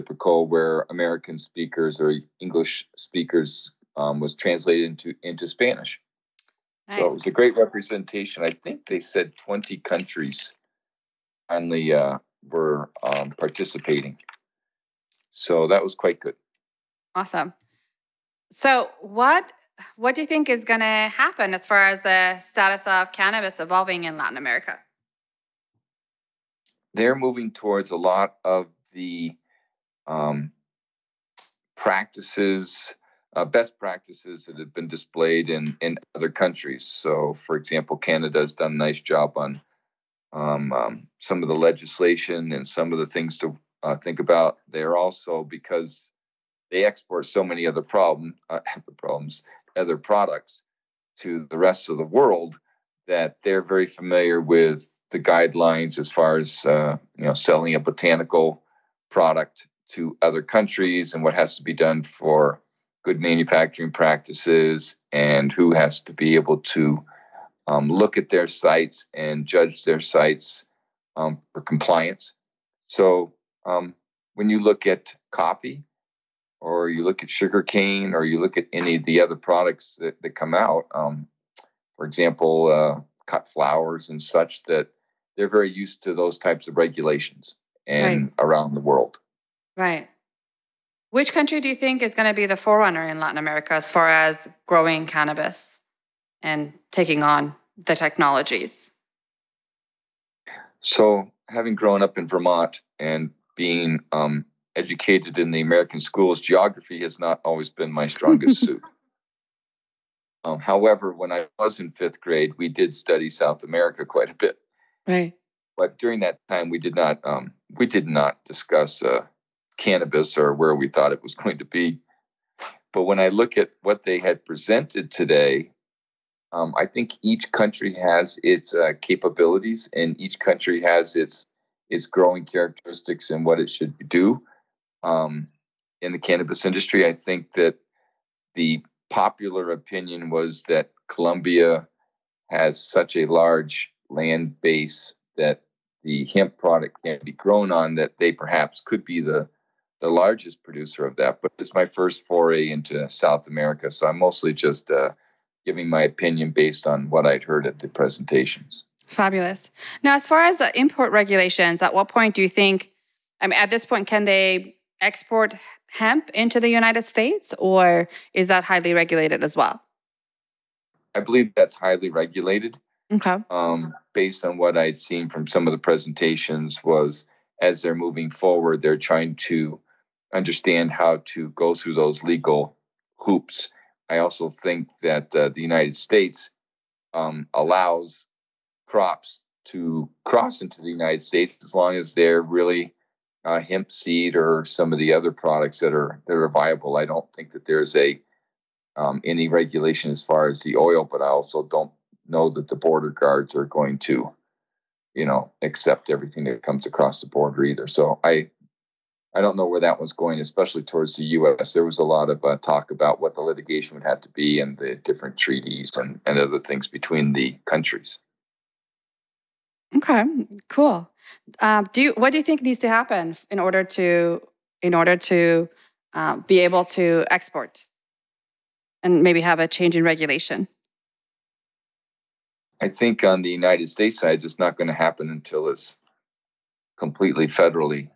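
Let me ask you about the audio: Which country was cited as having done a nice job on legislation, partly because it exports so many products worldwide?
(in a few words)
Canada.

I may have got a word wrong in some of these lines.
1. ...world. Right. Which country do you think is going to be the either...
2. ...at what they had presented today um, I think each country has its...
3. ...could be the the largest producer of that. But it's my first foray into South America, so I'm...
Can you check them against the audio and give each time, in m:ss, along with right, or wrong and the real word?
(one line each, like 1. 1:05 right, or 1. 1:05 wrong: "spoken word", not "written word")
1. 1:28 wrong: "forerunner", not "either"
2. 2:03 right
3. 2:28 right.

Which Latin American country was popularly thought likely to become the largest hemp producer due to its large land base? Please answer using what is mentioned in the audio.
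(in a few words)
Colombia.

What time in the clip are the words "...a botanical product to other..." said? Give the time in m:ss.
0:57.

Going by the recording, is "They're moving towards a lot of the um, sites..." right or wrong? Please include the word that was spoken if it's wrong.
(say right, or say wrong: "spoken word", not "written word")
wrong: "practices", not "sites".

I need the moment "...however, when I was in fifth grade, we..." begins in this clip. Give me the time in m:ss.
1:50.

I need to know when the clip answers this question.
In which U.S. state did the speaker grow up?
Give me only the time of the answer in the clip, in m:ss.
1:42.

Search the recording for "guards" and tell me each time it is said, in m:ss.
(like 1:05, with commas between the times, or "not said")
3:23.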